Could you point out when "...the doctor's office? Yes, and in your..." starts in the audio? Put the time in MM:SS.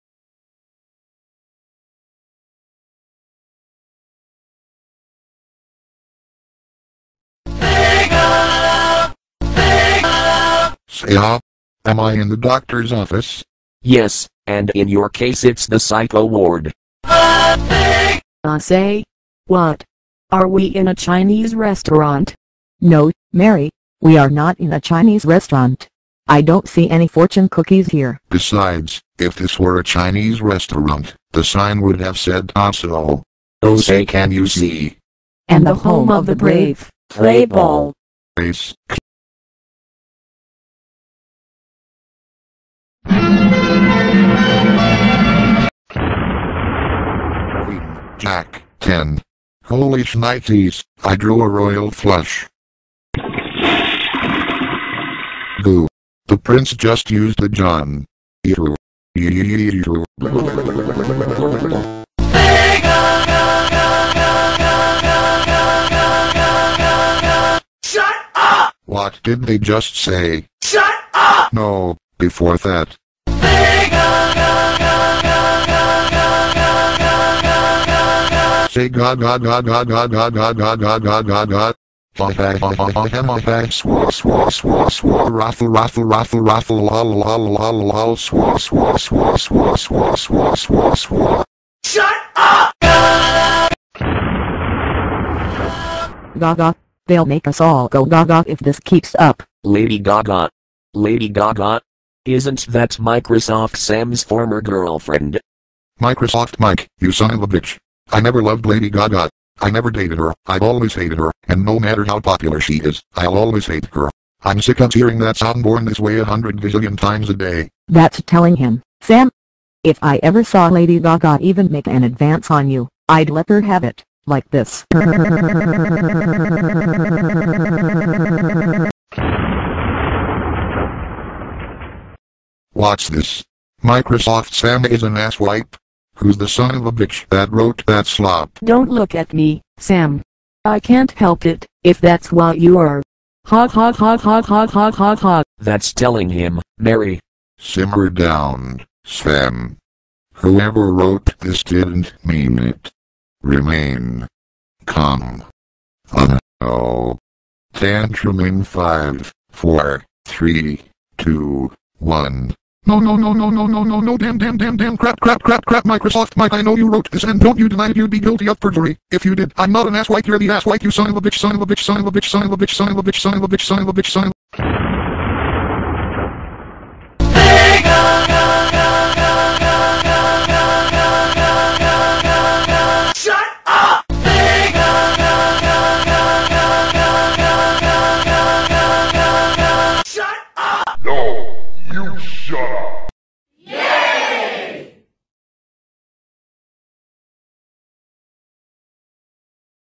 00:12.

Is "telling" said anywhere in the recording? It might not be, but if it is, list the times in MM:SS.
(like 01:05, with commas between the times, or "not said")
01:58, 02:25.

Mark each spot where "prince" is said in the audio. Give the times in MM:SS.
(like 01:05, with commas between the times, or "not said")
00:56.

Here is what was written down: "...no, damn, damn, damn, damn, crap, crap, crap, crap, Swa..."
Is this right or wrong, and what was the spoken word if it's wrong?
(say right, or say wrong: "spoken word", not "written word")
wrong: "Microsoft", not "Swa".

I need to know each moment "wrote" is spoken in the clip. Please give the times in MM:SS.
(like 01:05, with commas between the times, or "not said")
02:17, 02:30, 02:46.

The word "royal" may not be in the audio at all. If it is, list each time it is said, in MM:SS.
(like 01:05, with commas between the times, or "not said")
00:51.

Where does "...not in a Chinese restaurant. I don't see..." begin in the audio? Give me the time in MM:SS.
00:24.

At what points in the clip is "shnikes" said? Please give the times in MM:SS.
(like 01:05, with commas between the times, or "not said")
00:50.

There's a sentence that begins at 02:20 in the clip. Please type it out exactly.
I can't help it, if that's what you are.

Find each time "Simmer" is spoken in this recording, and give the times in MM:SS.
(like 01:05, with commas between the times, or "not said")
02:27.